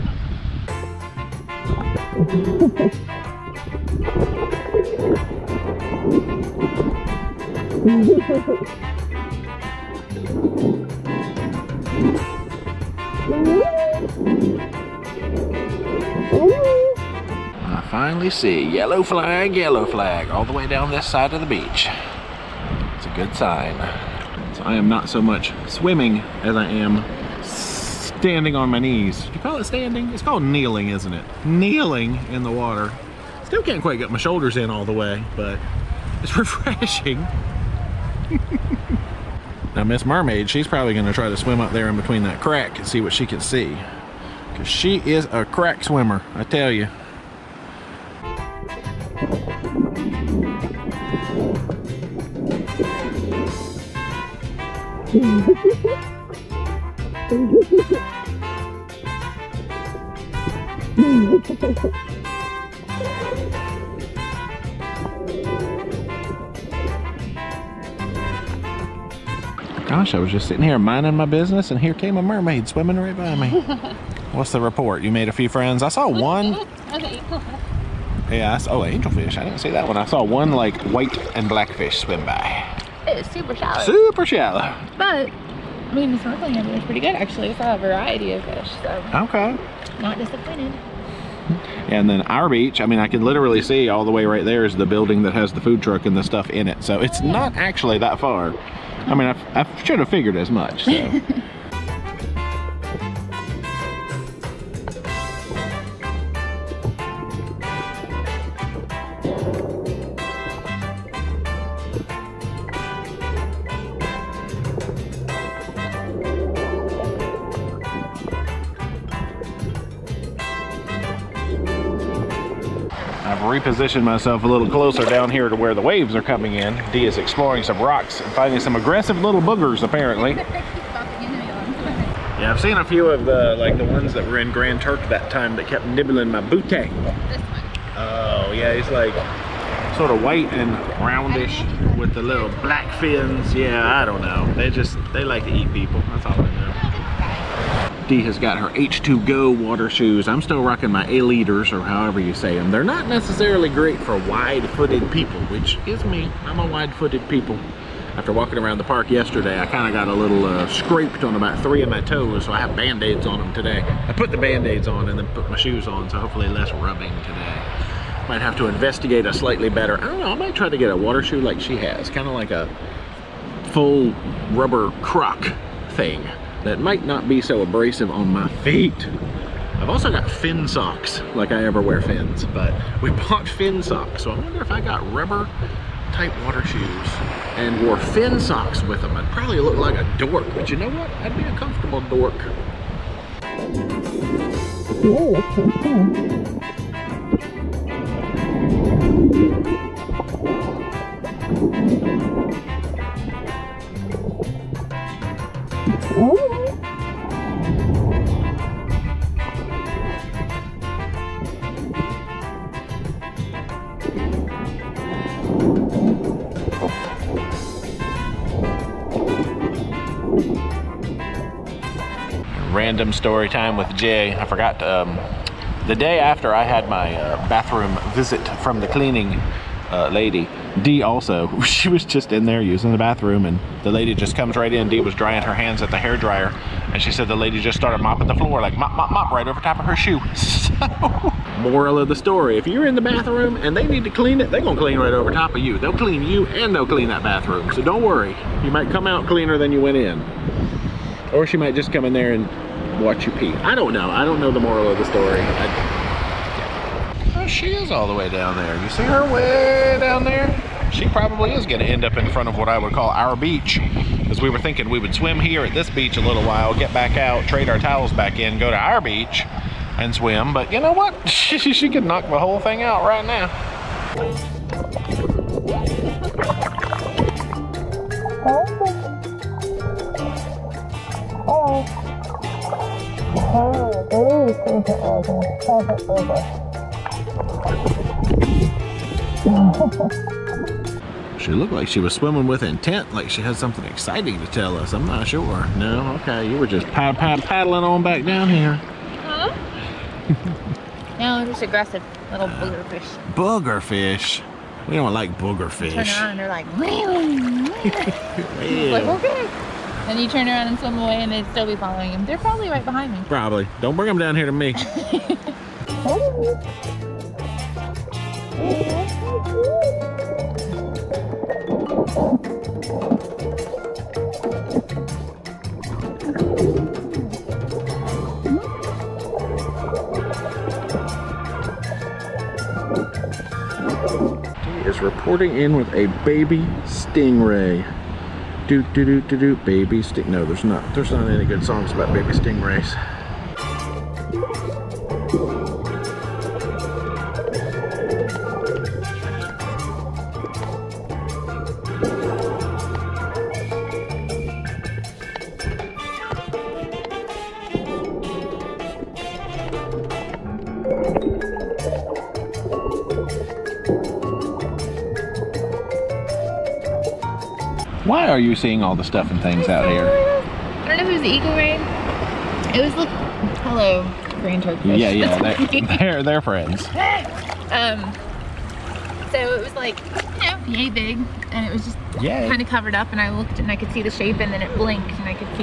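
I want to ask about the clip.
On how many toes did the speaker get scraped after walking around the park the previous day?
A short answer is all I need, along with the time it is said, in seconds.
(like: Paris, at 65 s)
3, at 161 s.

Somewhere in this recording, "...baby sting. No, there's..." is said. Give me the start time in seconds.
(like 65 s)
339 s.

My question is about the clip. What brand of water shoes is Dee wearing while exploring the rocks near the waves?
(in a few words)
H2 Go.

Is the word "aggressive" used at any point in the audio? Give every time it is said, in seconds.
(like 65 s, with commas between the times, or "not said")
128 s, 301 s.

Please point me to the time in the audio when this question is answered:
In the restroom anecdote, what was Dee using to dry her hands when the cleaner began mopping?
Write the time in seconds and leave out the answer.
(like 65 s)
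235 s.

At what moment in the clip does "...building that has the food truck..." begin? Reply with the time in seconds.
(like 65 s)
94 s.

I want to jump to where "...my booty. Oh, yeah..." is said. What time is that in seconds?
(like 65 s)
136 s.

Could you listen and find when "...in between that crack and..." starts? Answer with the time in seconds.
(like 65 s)
41 s.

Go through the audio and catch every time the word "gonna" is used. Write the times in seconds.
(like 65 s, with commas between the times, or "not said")
40 s, 244 s.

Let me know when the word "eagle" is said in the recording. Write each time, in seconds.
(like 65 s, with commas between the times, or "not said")
371 s.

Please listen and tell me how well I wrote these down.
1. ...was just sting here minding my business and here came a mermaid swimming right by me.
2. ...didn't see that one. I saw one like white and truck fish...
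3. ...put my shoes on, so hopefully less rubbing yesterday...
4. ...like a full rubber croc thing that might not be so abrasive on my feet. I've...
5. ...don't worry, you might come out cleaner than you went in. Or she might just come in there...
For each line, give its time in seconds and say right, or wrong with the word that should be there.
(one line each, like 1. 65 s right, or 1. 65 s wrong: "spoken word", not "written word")
1. 70 s wrong: "sitting", not "sting"
2. 79 s wrong: "black", not "truck"
3. 165 s wrong: "today", not "yesterday"
4. 172 s right
5. 247 s right.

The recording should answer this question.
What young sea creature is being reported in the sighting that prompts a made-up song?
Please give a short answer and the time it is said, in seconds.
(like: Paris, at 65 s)
baby stingray, at 336 s.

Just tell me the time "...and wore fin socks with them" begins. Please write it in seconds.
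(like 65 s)
187 s.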